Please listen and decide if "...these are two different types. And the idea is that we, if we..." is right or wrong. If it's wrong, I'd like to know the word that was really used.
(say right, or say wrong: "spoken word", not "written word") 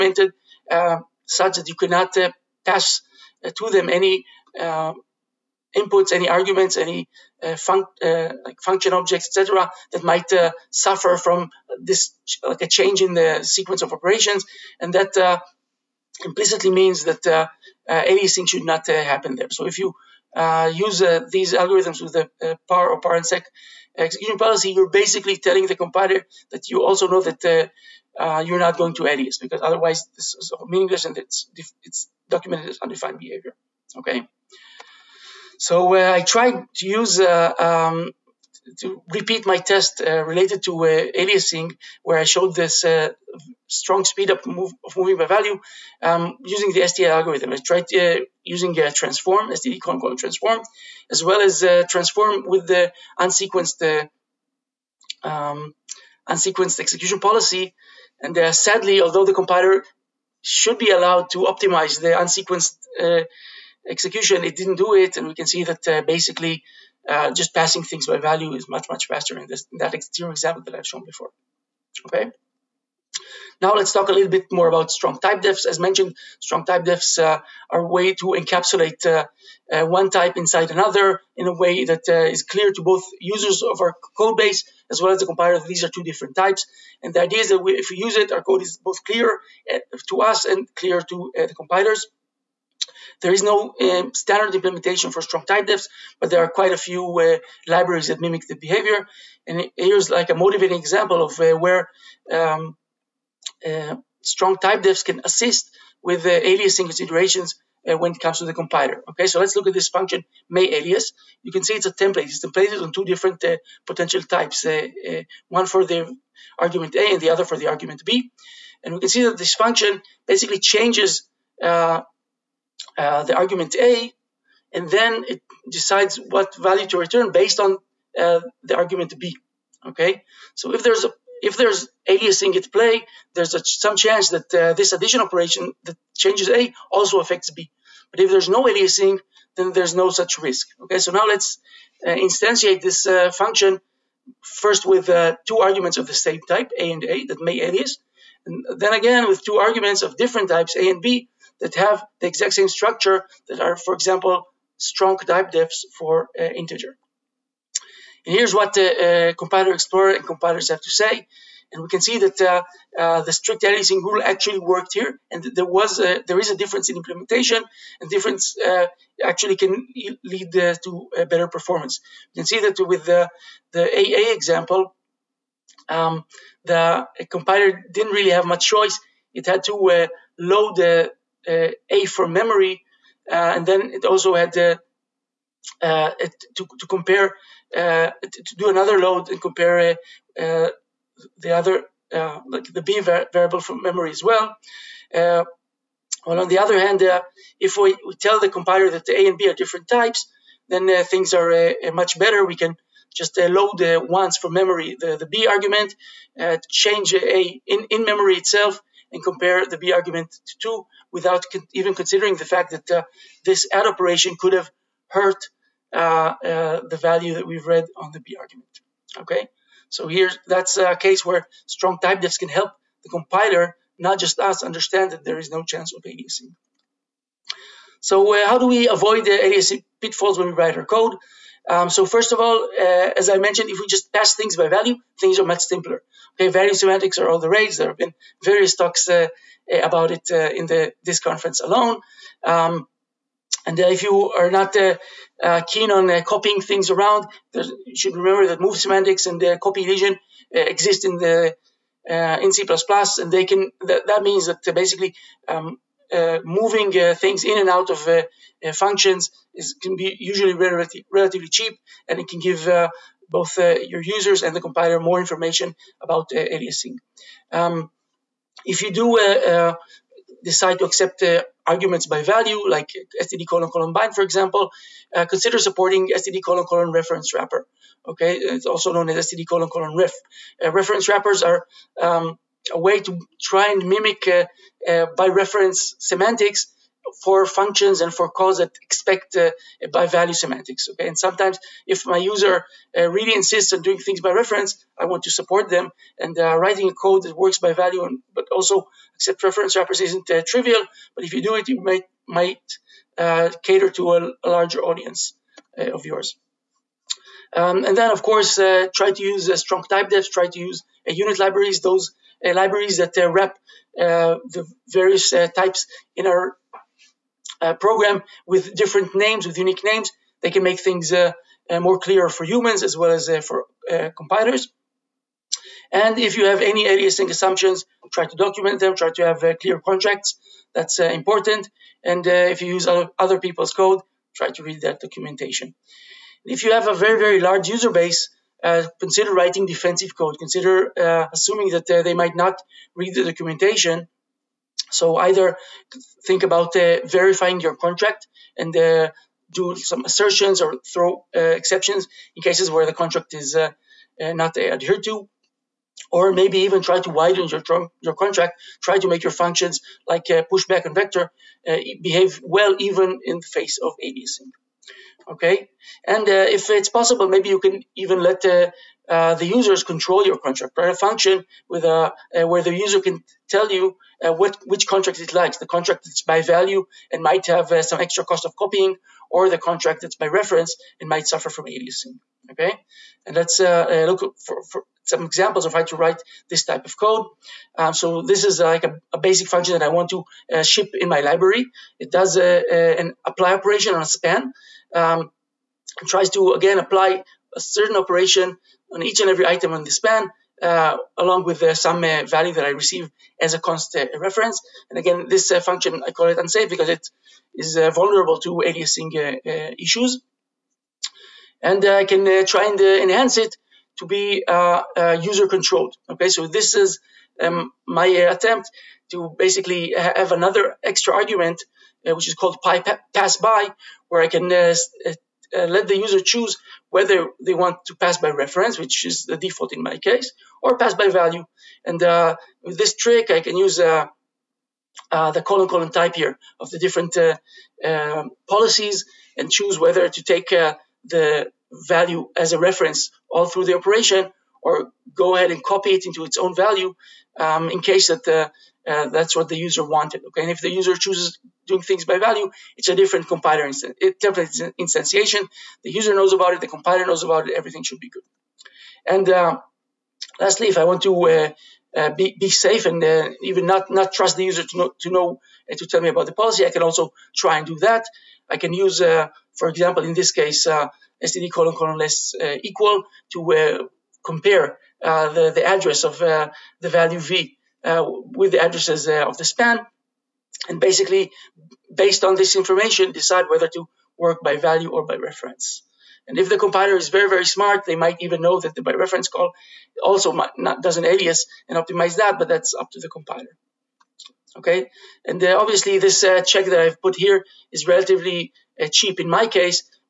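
right.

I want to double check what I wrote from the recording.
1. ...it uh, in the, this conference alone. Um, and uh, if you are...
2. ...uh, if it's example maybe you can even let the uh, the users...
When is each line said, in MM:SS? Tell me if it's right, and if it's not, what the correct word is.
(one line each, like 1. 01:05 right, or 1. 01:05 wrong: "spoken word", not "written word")
1. 04:00 right
2. 06:06 wrong: "possible", not "example".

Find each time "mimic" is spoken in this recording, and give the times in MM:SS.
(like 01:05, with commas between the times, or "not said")
01:38, 04:43.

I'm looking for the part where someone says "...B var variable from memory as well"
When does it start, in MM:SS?
03:12.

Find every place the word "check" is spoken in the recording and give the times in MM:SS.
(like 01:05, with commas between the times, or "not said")
08:16.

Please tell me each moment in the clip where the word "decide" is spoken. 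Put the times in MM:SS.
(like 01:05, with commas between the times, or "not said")
02:05, 04:30, 08:03.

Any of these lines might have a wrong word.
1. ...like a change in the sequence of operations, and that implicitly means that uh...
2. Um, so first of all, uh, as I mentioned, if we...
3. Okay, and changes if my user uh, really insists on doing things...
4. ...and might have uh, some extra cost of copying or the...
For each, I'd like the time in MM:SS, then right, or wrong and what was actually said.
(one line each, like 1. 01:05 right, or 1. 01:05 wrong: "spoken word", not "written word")
1. 00:12 right
2. 03:51 right
3. 04:50 wrong: "sometimes", not "changes"
4. 06:17 right.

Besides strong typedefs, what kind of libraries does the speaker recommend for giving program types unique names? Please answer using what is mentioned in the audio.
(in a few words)
unit libraries.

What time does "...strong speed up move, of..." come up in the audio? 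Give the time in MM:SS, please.
00:43.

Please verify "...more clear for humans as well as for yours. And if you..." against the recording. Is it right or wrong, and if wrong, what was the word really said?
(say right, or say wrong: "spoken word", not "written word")
wrong: "compilers", not "yours".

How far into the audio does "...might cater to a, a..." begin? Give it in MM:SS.
05:02.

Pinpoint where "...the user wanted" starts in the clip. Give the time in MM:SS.
07:29.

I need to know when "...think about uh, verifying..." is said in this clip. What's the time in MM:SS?
05:46.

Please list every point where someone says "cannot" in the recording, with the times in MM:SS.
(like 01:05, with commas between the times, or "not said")
00:01.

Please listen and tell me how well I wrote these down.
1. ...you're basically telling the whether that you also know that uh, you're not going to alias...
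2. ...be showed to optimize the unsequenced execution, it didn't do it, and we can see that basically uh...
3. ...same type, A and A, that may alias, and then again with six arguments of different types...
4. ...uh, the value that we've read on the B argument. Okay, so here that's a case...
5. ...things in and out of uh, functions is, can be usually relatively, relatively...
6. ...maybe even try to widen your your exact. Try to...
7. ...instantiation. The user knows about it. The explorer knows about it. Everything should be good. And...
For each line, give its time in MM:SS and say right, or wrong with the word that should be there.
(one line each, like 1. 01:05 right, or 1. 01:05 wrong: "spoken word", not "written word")
1. 00:24 wrong: "compiler", not "whether"
2. 01:00 wrong: "allowed", not "showed"
3. 02:26 wrong: "two", not "six"
4. 03:36 right
5. 04:17 right
6. 05:56 wrong: "contract", not "exact"
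7. 07:34 wrong: "compiler", not "explorer".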